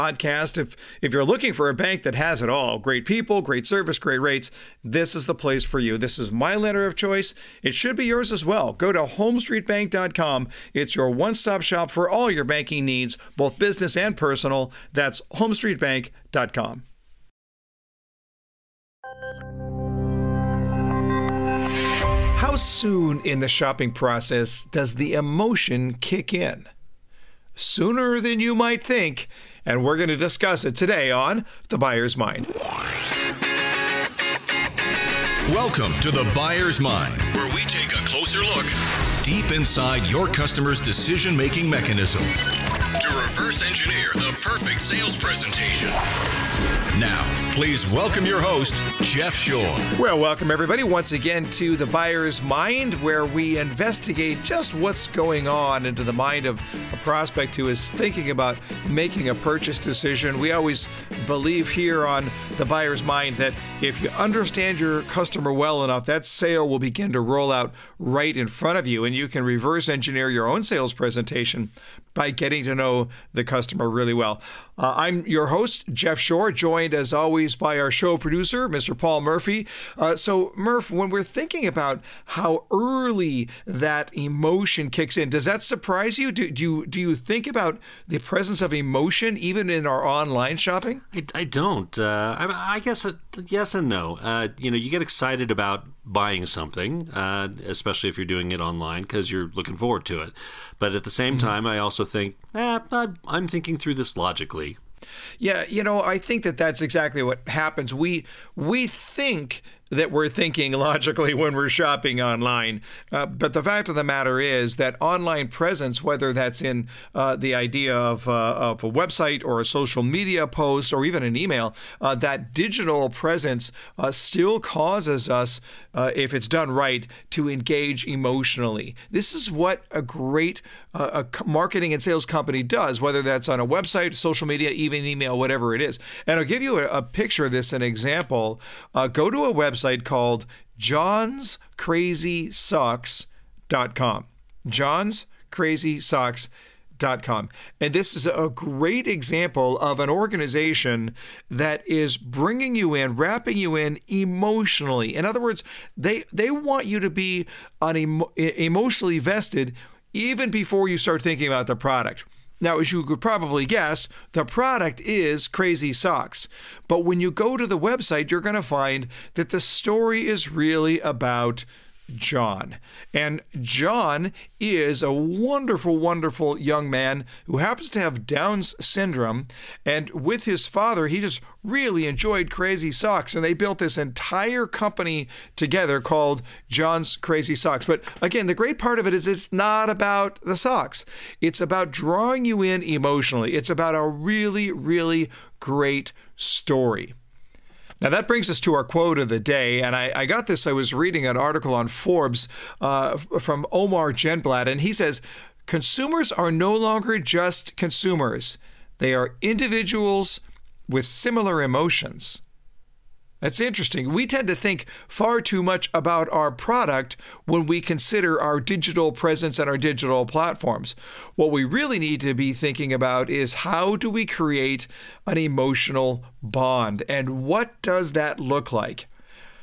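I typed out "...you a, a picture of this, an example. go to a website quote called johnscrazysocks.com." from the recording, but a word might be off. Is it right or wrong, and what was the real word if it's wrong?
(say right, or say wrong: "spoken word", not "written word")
wrong: "website", not "quote".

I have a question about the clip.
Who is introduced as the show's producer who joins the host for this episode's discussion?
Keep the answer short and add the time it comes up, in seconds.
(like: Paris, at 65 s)
Paul Murphy, at 78 s.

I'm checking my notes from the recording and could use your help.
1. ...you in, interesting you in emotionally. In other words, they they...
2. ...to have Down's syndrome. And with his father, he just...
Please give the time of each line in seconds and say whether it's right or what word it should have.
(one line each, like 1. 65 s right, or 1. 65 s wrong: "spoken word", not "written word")
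1. 152 s wrong: "wrapping", not "interesting"
2. 177 s right.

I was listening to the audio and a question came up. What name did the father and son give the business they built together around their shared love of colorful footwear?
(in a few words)
John's Crazy Socks.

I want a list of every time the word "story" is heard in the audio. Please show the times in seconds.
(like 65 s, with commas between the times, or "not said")
169 s, 196 s.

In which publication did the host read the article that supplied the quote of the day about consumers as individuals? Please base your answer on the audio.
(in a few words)
Forbes.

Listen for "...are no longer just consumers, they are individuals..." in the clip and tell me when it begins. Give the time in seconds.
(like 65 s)
206 s.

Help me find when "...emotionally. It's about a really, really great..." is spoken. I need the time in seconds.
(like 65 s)
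192 s.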